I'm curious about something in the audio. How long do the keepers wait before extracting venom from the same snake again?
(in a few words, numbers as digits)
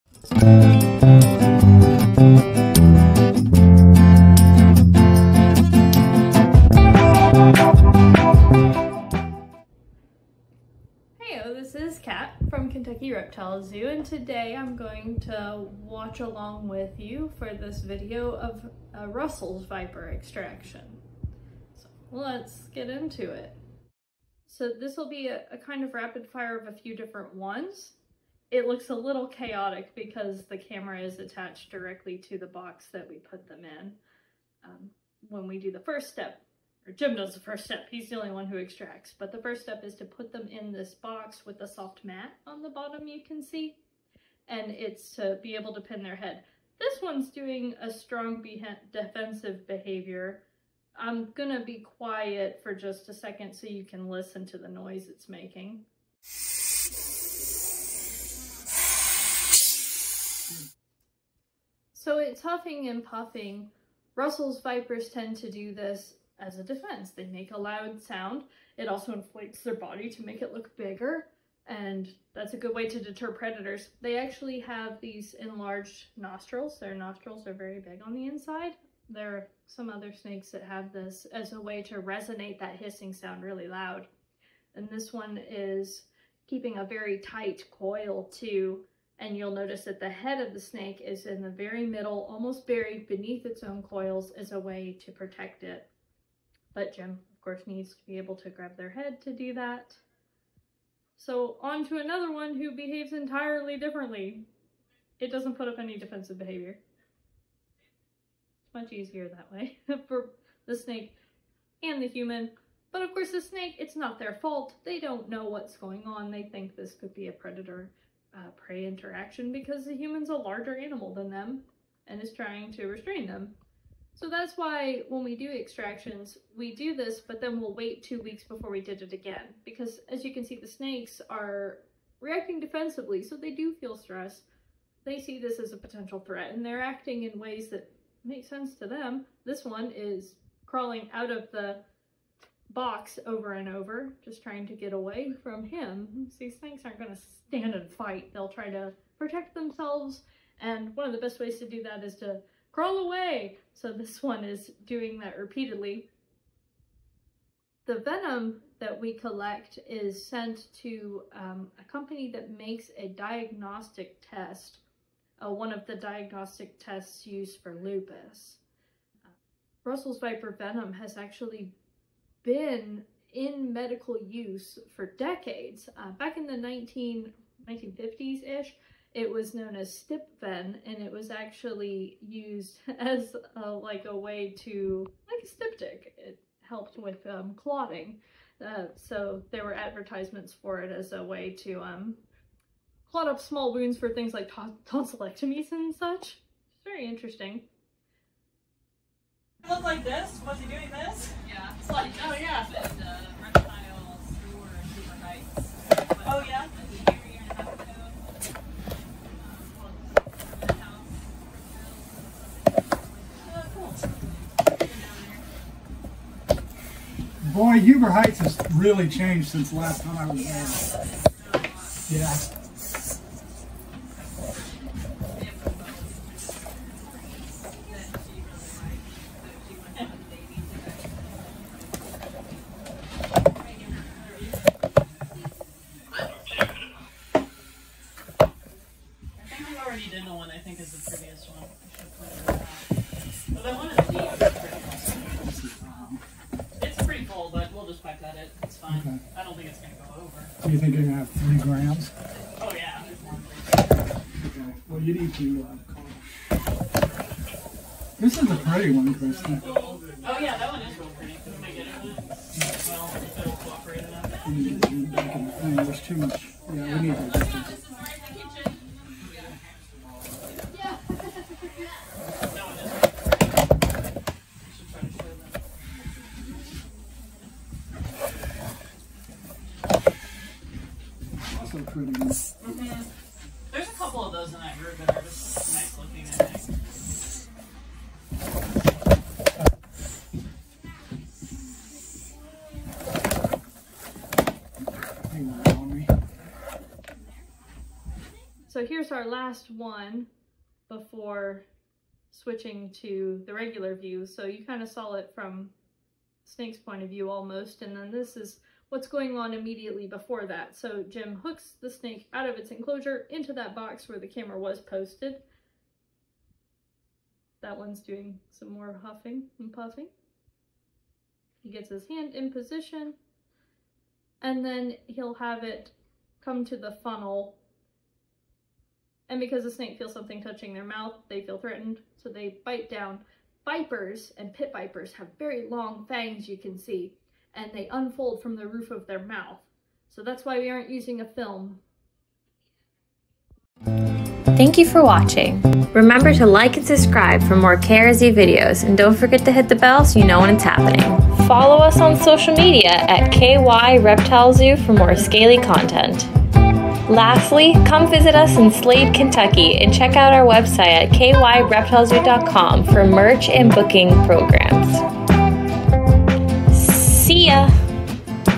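two weeks.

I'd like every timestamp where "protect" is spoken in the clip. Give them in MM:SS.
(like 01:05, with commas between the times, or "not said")
01:35, 02:29.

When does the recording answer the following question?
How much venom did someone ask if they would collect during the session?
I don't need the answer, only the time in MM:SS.
04:11.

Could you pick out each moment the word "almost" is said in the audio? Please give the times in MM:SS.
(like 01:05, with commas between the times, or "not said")
01:32, 05:07.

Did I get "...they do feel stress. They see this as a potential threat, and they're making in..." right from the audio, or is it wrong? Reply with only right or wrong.
wrong.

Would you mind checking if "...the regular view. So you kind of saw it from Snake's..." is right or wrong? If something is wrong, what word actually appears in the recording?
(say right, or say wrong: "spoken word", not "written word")
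right.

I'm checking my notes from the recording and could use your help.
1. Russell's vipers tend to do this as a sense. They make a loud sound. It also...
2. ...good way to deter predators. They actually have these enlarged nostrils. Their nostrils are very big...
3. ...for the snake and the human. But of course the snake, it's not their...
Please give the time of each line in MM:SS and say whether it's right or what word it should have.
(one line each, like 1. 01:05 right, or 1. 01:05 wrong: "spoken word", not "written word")
1. 01:04 wrong: "defense", not "sense"
2. 01:12 right
3. 01:50 right.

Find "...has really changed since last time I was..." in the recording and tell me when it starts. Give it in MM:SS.
03:38.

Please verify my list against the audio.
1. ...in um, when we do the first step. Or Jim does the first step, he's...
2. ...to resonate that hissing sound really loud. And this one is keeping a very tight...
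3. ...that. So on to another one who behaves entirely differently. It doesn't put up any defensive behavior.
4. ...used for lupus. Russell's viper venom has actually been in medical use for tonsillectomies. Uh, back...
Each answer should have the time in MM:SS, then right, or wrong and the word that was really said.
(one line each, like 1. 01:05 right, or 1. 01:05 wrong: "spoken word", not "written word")
1. 00:33 right
2. 01:21 right
3. 01:39 right
4. 02:47 wrong: "decades", not "tonsillectomies".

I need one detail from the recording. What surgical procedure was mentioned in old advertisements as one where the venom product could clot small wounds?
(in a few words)
tonsillectomies.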